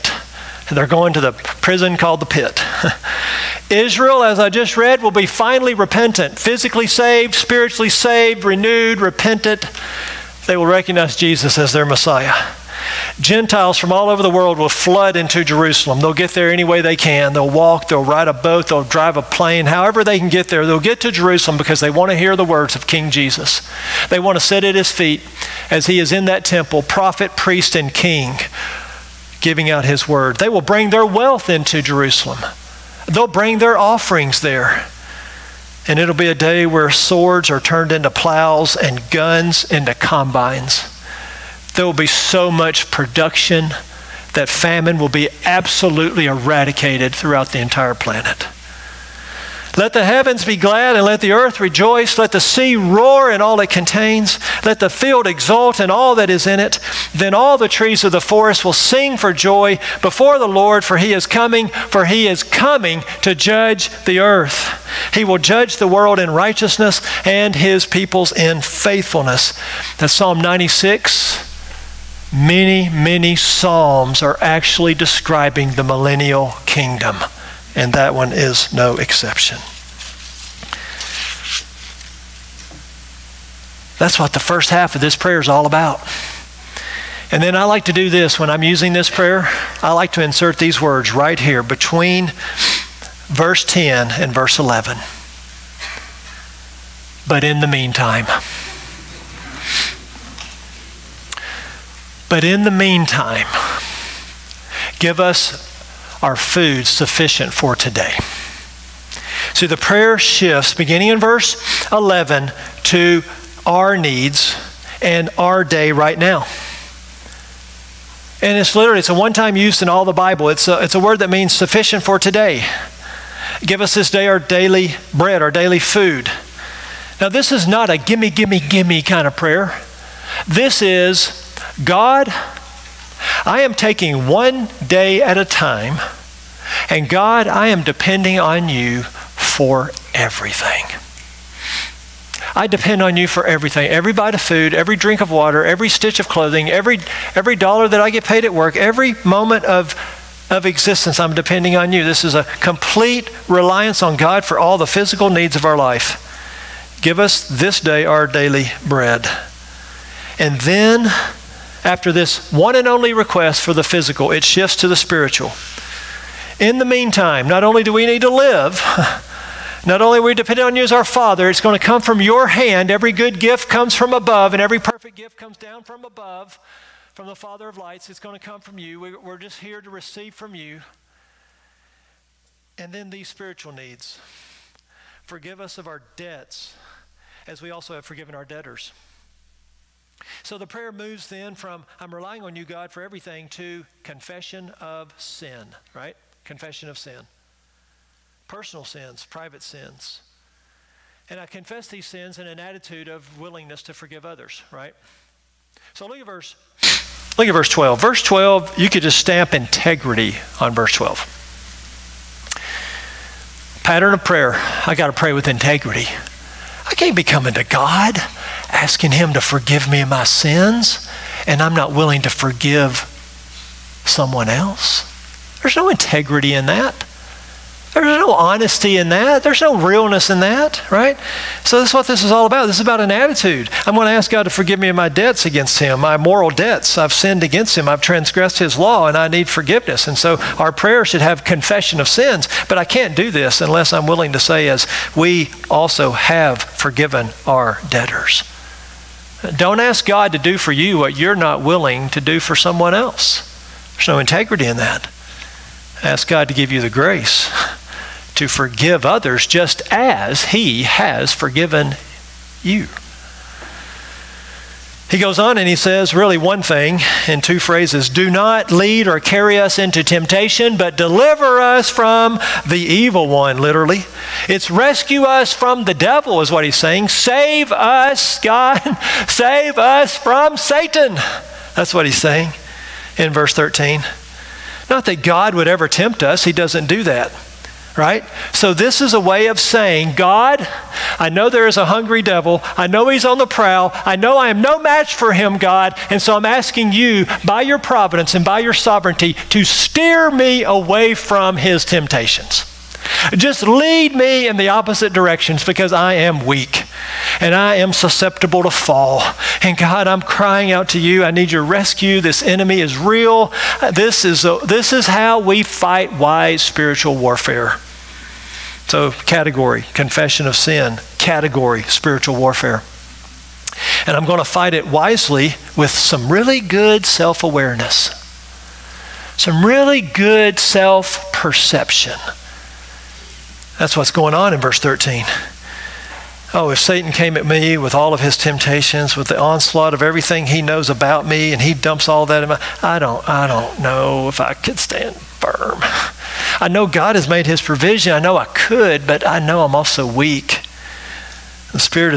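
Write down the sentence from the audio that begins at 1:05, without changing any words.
He will judge the world in righteousness and his peoples in faithfulness.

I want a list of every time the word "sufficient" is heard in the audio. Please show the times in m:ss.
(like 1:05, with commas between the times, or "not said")
1:46, 2:01.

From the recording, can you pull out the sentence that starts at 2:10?
This is, God, I am taking one day at a time, and God, I am depending on you for everything.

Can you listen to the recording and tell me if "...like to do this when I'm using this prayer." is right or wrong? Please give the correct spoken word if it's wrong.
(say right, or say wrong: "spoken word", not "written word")
right.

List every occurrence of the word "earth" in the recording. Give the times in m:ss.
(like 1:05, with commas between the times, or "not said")
0:51, 1:04.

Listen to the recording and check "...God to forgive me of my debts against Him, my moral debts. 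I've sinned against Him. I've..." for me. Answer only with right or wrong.
right.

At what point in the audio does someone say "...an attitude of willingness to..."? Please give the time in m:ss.
3:22.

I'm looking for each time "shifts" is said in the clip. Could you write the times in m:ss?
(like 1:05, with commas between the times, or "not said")
1:50, 2:44.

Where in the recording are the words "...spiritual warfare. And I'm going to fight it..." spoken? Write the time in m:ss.
5:21.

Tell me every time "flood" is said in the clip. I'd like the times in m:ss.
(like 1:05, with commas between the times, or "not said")
0:14.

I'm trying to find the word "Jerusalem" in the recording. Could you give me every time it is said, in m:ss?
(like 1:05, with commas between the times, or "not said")
0:15, 0:21, 0:31.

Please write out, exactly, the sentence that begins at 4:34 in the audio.
It's rescue us from the devil, is what he's saying.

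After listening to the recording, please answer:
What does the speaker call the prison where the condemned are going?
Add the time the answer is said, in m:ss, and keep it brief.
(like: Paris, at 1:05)
the pit, at 0:02.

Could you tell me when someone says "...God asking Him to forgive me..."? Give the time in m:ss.
3:37.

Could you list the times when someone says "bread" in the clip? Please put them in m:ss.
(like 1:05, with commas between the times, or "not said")
2:05, 2:38.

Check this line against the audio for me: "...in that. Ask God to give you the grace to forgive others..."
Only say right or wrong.
right.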